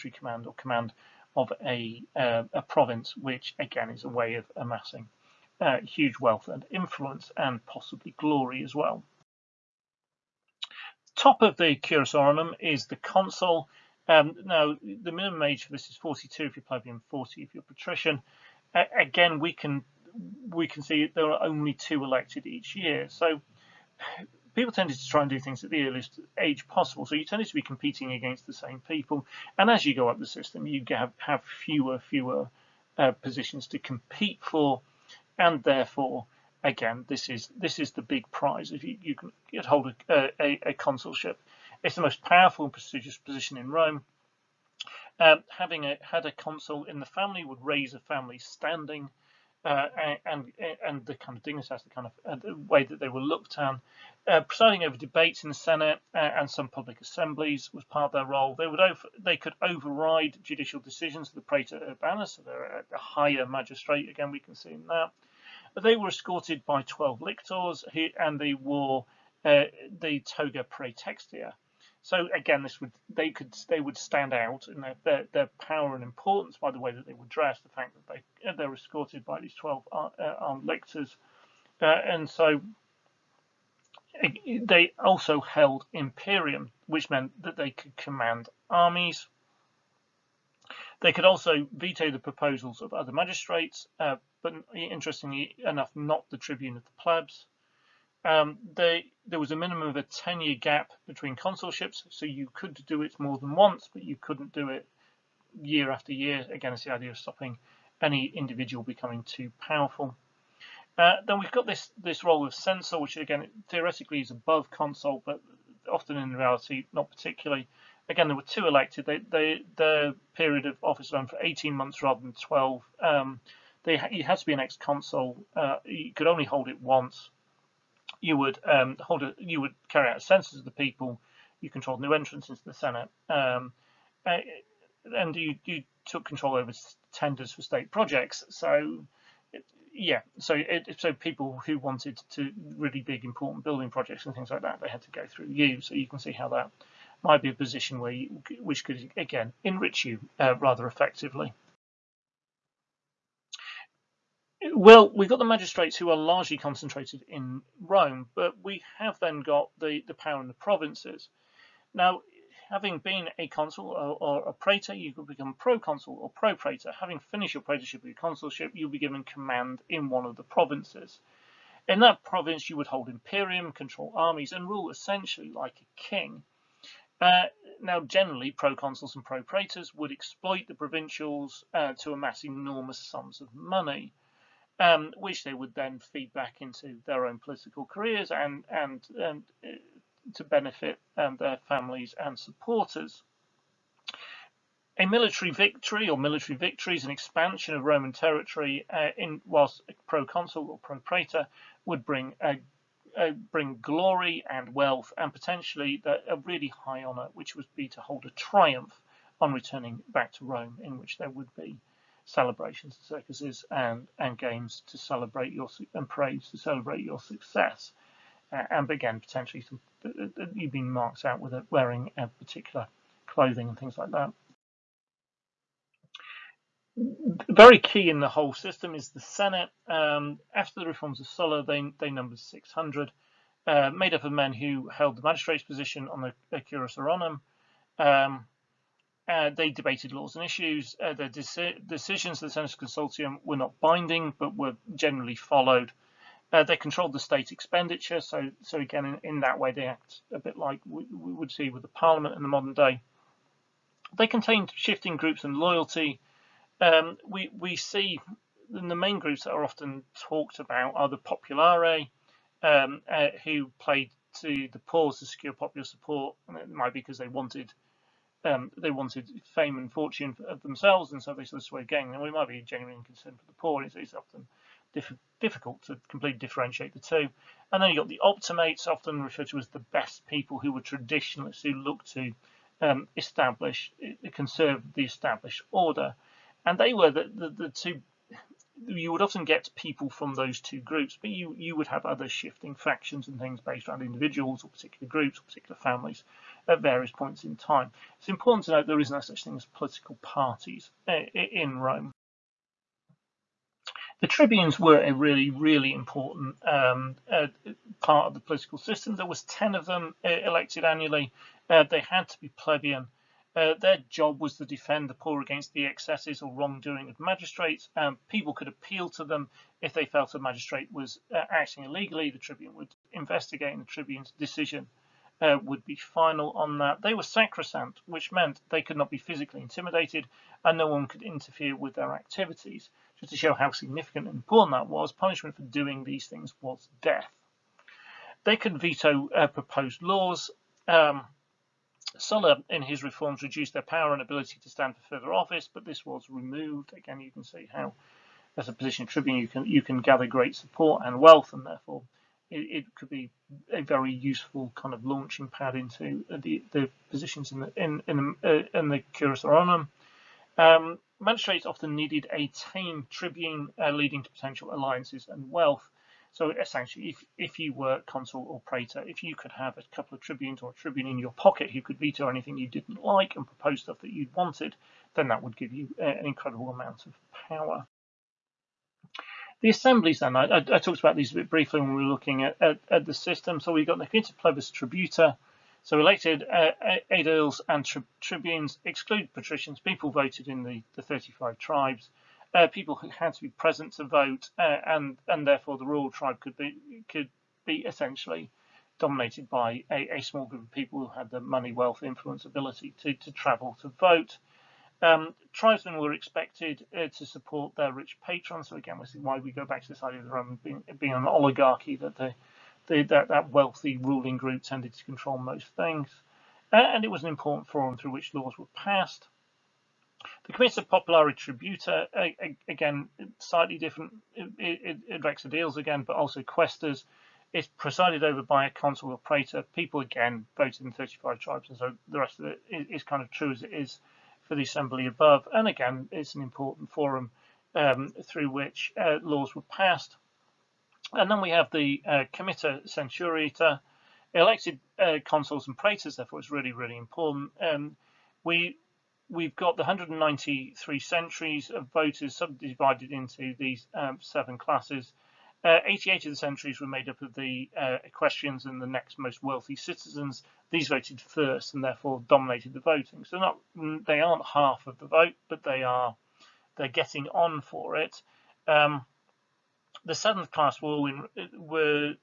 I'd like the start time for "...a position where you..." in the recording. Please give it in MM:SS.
02:27.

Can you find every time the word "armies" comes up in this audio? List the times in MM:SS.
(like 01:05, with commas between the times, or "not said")
01:28, 02:54.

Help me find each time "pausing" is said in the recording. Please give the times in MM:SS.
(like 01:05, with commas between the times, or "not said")
not said.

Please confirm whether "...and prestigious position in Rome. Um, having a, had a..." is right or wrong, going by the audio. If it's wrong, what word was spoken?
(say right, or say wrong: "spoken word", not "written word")
right.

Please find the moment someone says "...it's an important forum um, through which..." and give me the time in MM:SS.
07:16.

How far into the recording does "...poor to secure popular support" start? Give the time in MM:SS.
04:24.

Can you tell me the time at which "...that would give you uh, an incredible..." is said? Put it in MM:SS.
06:15.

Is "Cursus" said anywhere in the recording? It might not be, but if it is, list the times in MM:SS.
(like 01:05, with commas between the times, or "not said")
00:11, 03:56.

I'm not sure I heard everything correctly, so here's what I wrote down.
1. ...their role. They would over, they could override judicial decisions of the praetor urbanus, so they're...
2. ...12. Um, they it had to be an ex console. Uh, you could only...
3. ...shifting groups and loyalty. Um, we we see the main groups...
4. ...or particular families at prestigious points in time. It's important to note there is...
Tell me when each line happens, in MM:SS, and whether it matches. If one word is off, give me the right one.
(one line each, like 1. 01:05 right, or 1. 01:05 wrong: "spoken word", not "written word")
1. 00:58 right
2. 02:02 right
3. 04:14 right
4. 04:55 wrong: "various", not "prestigious".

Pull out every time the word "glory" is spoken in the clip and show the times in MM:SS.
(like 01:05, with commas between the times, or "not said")
00:08, 03:23.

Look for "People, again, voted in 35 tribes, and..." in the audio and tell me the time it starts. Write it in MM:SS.
07:09.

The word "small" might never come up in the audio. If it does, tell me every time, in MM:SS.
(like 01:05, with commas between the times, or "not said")
06:40.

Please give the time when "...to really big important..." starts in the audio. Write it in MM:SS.
02:22.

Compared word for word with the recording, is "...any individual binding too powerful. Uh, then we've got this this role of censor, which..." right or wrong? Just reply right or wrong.
wrong.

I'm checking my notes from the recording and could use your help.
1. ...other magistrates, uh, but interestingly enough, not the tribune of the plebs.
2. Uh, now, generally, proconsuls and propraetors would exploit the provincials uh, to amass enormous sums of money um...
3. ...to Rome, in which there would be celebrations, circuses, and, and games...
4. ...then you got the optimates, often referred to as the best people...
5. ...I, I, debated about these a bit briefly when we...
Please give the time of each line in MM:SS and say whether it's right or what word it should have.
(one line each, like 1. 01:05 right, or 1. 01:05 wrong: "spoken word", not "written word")
1. 01:32 right
2. 02:57 right
3. 03:30 right
4. 04:37 right
5. 06:20 wrong: "talked", not "debated".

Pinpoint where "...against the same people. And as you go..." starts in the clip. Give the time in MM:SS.
00:28.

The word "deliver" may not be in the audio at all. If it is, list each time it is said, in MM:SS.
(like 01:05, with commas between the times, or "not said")
not said.